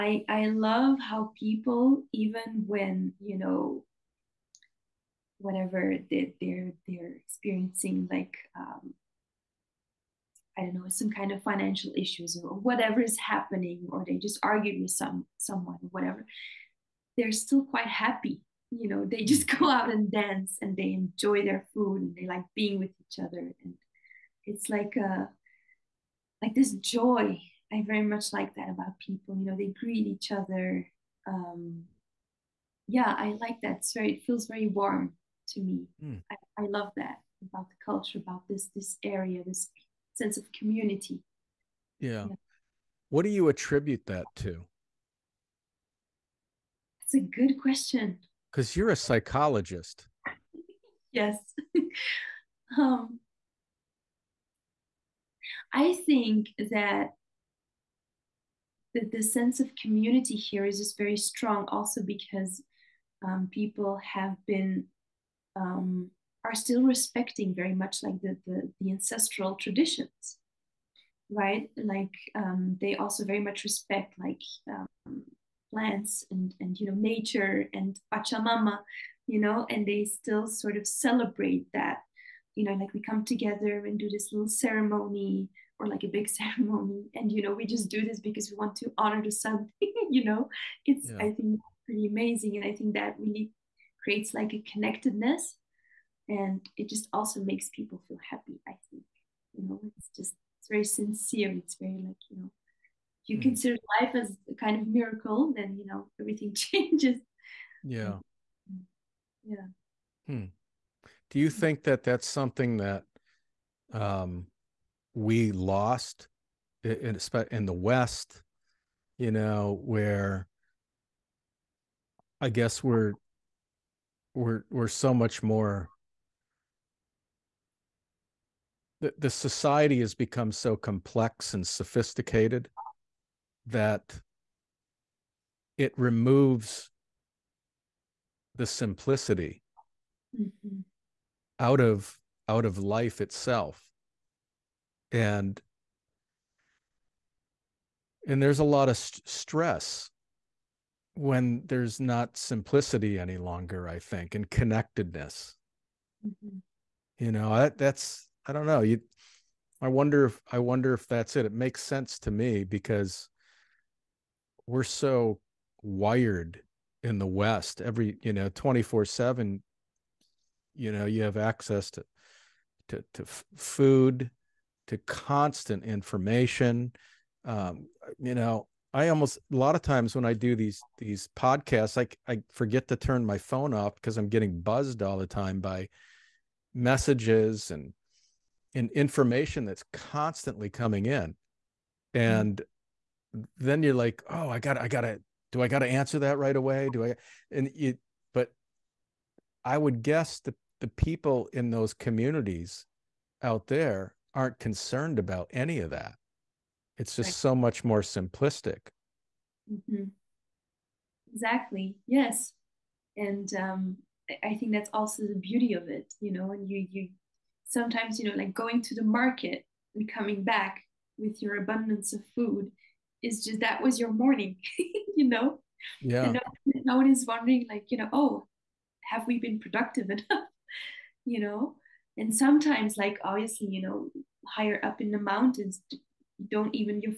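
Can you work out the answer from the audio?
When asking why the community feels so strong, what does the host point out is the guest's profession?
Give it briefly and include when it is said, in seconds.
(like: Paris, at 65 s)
Psychologist, at 48 s.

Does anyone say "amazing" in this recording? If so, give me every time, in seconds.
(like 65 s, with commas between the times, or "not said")
92 s.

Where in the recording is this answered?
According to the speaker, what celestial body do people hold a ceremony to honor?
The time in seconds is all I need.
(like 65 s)
89 s.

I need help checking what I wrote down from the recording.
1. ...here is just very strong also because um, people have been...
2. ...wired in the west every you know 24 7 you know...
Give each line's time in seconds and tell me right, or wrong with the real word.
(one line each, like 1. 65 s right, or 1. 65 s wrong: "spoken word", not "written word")
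1. 60 s right
2. 165 s right.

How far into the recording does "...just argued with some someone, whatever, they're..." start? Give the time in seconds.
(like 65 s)
14 s.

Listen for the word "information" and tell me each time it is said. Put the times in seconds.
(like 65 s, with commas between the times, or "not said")
175 s, 188 s.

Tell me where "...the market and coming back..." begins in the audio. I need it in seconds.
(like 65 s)
218 s.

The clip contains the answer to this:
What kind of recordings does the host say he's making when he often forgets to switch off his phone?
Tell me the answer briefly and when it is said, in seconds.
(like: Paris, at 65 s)
Podcasts, at 181 s.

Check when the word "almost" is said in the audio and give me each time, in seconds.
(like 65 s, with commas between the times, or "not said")
179 s.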